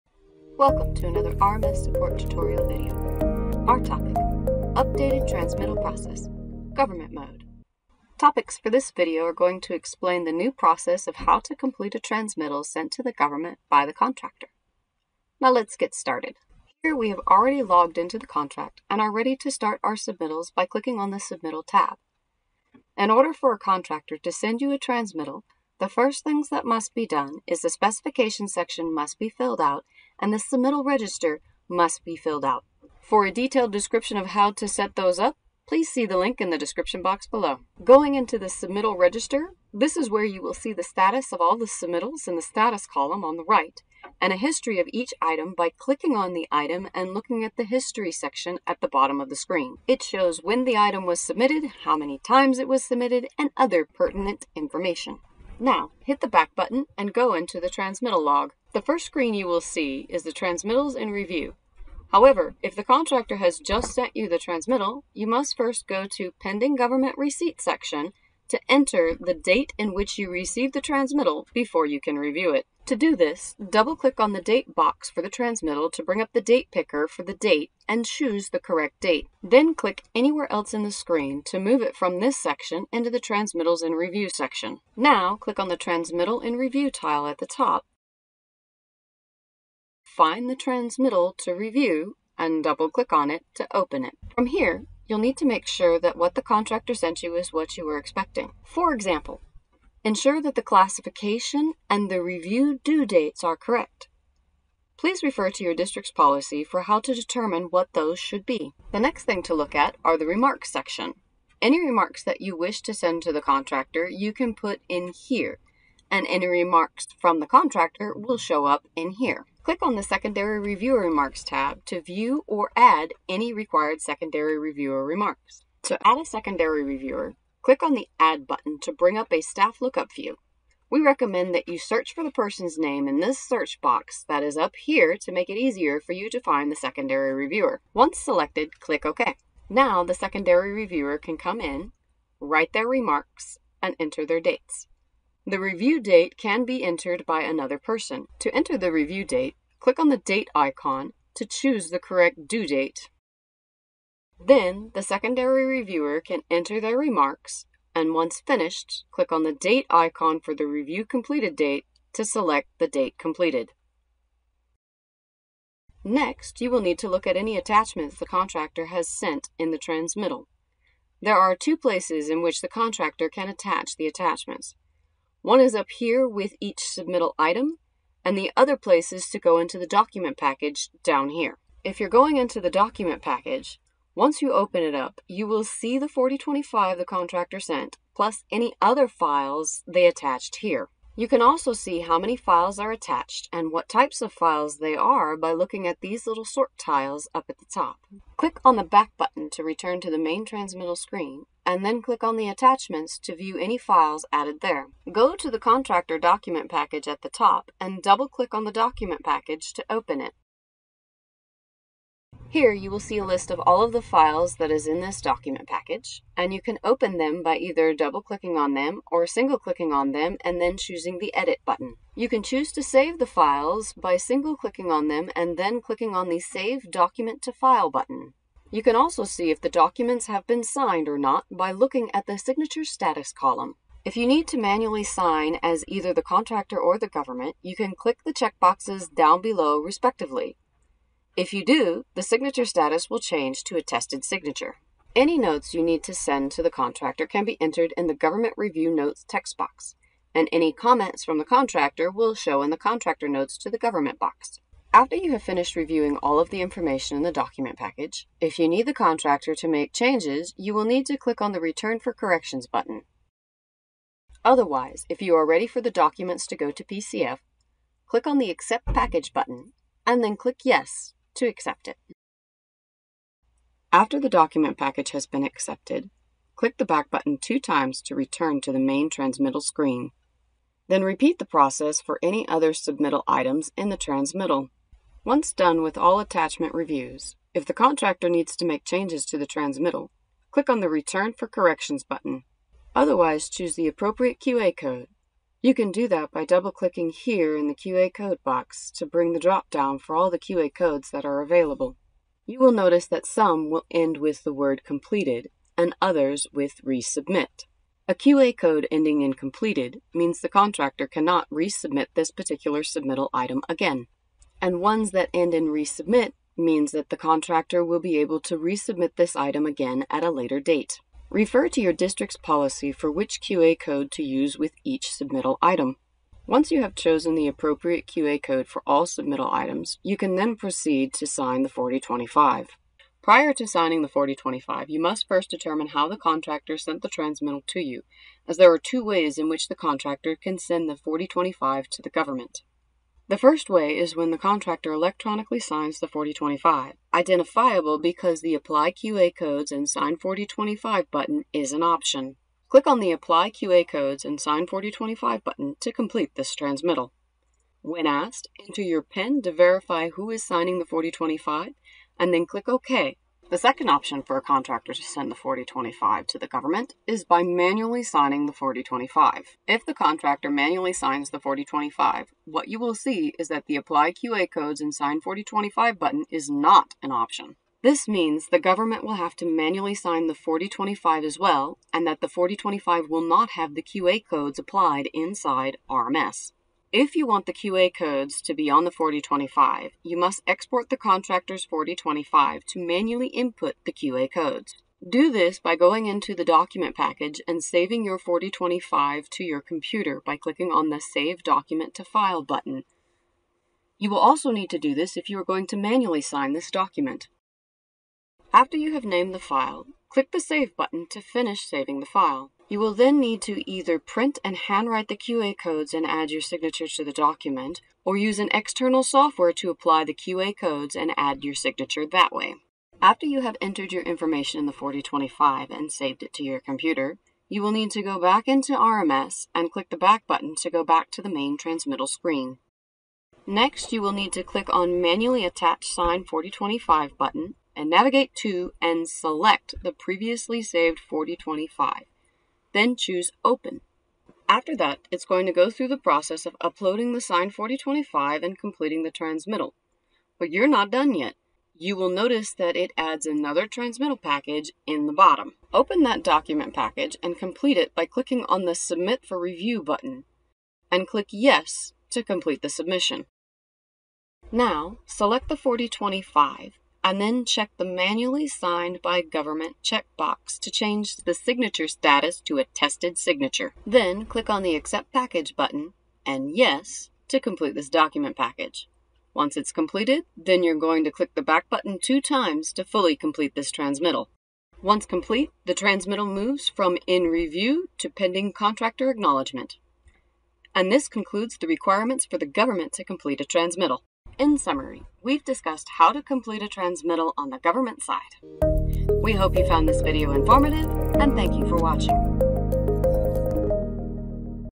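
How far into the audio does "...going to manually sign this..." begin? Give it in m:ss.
6:45.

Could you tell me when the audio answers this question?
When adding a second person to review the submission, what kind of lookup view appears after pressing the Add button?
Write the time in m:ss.
2:09.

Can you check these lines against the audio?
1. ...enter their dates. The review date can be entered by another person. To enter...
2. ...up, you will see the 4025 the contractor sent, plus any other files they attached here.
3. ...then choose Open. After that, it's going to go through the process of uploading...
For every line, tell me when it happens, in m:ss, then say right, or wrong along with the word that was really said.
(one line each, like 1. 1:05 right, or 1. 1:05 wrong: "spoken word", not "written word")
1. 2:23 right
2. 3:04 right
3. 7:22 right.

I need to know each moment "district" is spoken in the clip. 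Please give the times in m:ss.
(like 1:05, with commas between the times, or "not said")
1:45, 5:21.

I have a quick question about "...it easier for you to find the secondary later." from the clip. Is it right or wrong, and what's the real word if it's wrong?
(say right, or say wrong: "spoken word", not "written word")
wrong: "reviewer", not "later".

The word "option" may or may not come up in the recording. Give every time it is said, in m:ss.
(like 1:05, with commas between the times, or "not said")
5:51, 6:03, 6:17.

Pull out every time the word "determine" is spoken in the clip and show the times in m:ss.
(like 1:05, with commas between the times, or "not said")
1:47, 5:35.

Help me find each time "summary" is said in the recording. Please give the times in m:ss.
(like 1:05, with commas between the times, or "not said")
8:14.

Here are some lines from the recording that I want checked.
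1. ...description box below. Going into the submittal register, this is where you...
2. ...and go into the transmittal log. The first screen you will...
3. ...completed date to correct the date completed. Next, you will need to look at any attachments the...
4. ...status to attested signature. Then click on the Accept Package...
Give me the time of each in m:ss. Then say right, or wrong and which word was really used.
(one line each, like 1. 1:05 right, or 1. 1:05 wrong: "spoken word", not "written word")
1. 0:36 right
2. 0:56 right
3. 2:41 wrong: "select", not "correct"
4. 7:51 right.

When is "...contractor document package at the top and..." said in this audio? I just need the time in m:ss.
3:25.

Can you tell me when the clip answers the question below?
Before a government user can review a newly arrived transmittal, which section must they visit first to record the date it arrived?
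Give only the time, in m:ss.
1:06.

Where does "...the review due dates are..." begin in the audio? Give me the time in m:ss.
1:42.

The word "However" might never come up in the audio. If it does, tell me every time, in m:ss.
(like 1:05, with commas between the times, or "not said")
1:02.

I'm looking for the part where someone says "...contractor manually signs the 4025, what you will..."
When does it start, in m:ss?
6:09.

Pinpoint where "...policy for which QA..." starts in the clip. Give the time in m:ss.
5:22.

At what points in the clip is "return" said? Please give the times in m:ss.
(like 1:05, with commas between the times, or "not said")
3:19, 4:21, 4:38, 4:50.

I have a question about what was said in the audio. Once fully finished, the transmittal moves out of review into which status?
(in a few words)
pending contractor acknowledgement.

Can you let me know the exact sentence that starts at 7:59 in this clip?
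Once it's completed, then you're going to click the back button two times to fully complete this transmittal.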